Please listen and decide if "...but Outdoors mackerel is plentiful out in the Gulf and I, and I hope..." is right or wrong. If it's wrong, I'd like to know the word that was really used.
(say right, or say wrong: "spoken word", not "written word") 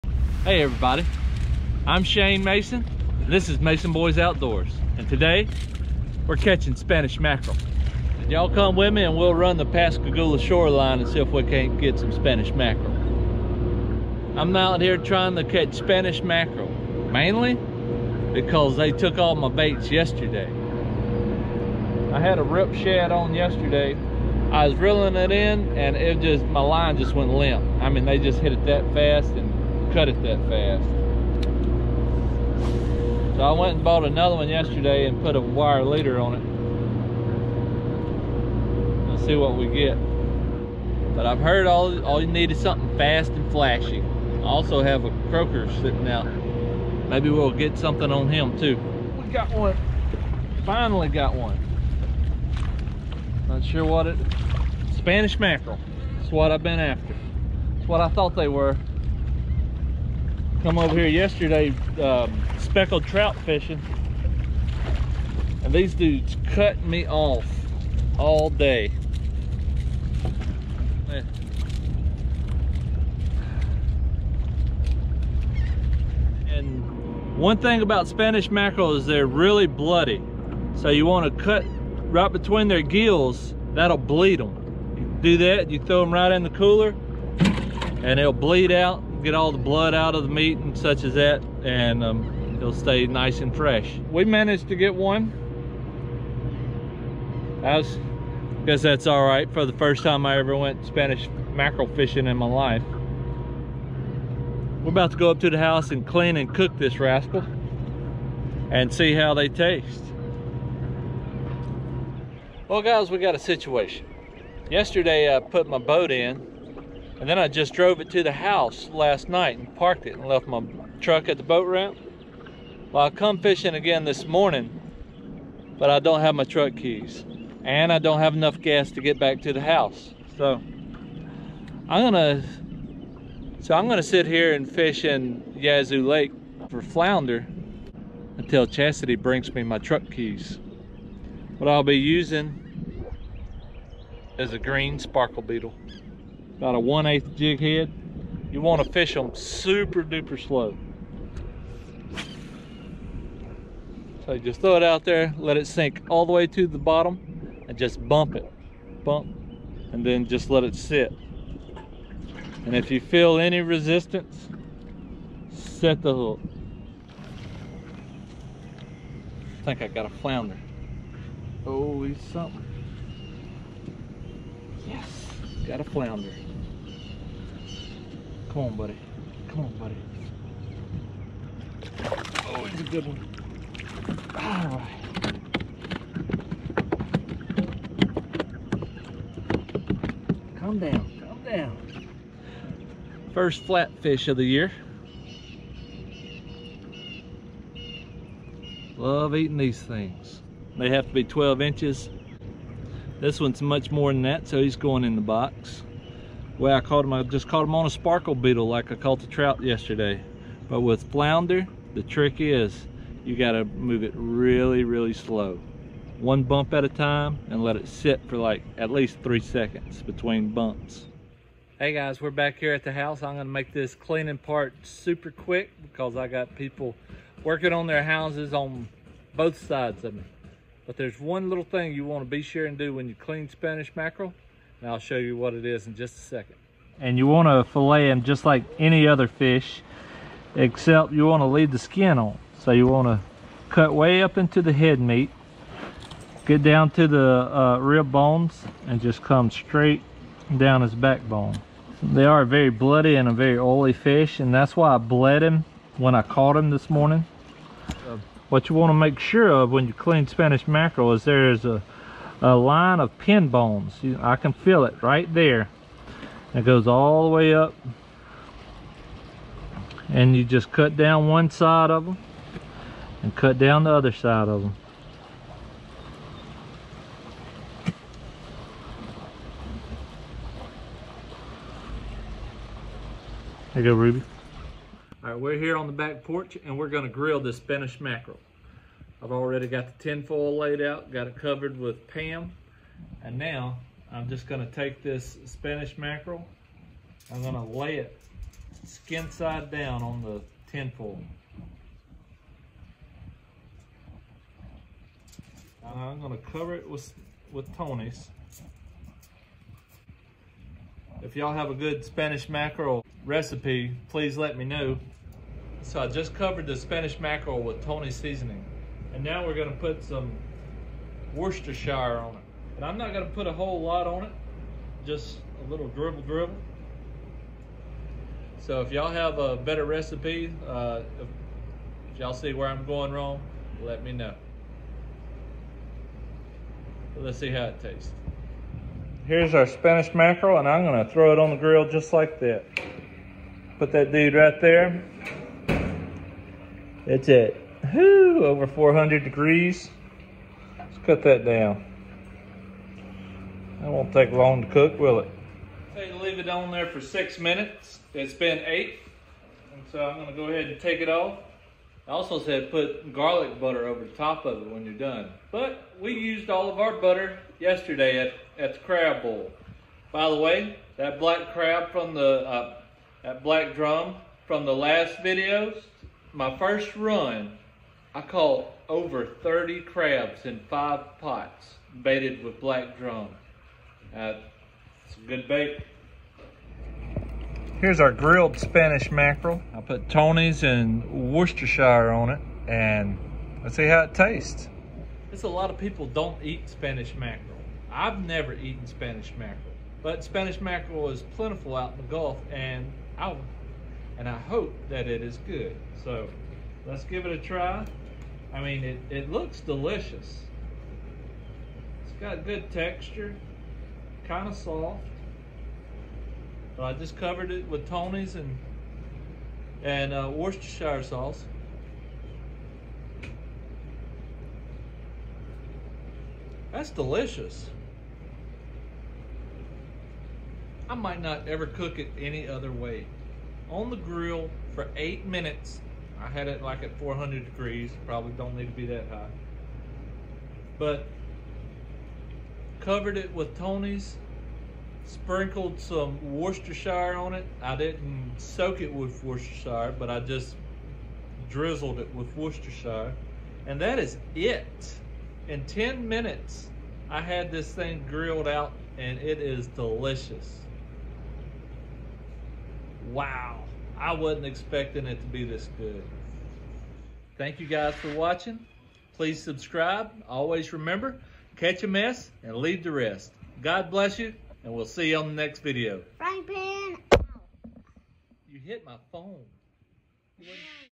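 wrong: "Spanish", not "Outdoors".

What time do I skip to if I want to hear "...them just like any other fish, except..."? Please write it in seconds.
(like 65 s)
238 s.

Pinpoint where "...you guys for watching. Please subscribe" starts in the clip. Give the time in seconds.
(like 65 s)
467 s.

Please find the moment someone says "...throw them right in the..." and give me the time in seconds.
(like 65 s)
85 s.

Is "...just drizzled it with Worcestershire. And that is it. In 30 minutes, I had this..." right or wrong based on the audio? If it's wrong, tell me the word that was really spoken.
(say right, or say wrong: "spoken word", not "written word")
wrong: "10", not "30".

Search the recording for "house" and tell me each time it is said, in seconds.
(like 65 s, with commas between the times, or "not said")
105 s, 118 s, 129 s, 222 s, 228 s.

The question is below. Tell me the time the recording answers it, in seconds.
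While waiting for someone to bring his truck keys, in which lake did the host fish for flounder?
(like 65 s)
135 s.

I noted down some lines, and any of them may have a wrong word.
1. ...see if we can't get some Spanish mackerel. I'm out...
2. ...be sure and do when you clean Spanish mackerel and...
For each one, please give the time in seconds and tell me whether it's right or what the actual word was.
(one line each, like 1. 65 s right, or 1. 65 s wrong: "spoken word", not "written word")
1. 11 s right
2. 232 s right.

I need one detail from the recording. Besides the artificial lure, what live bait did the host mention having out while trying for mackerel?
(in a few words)
Croaker.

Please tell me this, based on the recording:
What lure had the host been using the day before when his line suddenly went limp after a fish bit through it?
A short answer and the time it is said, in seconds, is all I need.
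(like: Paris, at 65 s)
Rip shad, at 22 s.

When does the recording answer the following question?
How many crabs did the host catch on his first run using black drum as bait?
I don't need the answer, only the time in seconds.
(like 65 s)
378 s.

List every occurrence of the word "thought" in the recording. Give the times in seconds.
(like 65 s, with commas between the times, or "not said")
58 s.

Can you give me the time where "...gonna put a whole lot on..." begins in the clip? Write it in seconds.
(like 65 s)
323 s.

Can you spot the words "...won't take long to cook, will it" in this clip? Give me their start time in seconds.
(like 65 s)
353 s.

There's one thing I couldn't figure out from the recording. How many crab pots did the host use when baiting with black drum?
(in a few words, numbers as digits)
5.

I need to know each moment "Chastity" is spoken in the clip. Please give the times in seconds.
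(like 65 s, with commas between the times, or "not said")
138 s.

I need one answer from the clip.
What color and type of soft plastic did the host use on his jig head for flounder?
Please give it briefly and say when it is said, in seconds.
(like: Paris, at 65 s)
Green sparkle beetle, at 144 s.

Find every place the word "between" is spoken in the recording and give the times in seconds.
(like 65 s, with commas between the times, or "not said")
82 s, 220 s.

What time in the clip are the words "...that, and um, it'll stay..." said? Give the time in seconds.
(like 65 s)
91 s.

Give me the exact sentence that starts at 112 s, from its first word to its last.
Well guys, we got a situation.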